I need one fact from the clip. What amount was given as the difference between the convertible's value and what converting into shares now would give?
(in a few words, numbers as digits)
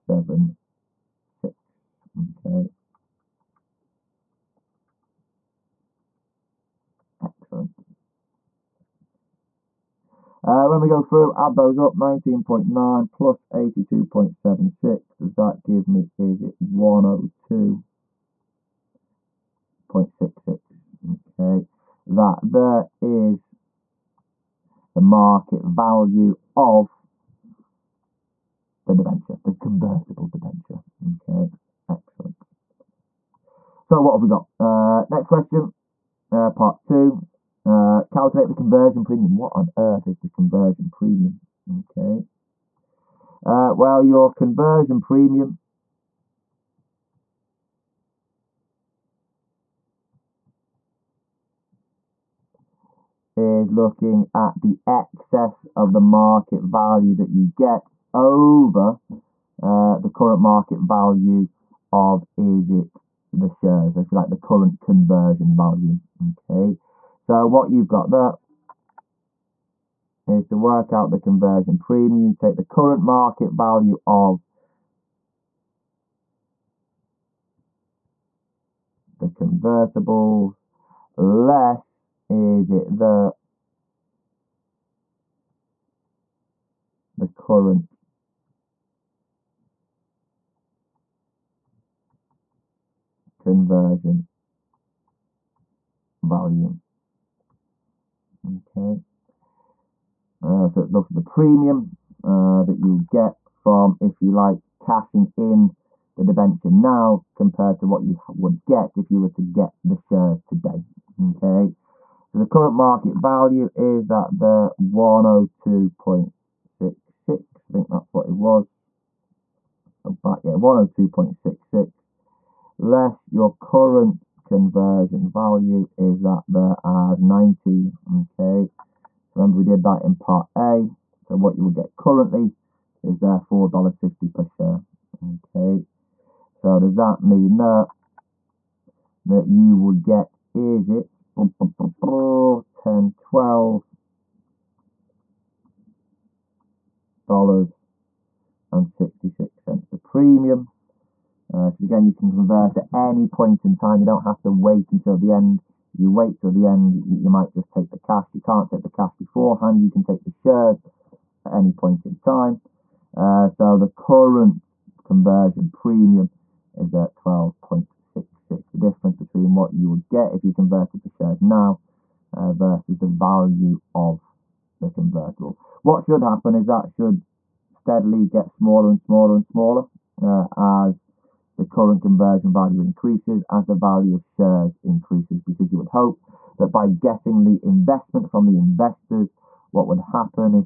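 12.66.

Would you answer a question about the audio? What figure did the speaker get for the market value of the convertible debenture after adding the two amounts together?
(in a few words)
102.66.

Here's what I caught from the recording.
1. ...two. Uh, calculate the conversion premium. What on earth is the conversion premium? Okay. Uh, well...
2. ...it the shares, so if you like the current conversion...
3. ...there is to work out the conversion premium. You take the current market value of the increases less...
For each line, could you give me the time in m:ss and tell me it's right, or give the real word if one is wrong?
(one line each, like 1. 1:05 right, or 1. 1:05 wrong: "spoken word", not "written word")
1. 0:36 right
2. 1:02 right
3. 1:08 wrong: "convertibles", not "increases".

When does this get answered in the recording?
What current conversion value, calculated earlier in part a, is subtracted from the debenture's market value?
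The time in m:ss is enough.
2:07.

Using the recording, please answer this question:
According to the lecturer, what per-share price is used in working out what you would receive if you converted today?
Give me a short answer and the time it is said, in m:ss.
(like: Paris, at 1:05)
$4.50, at 2:13.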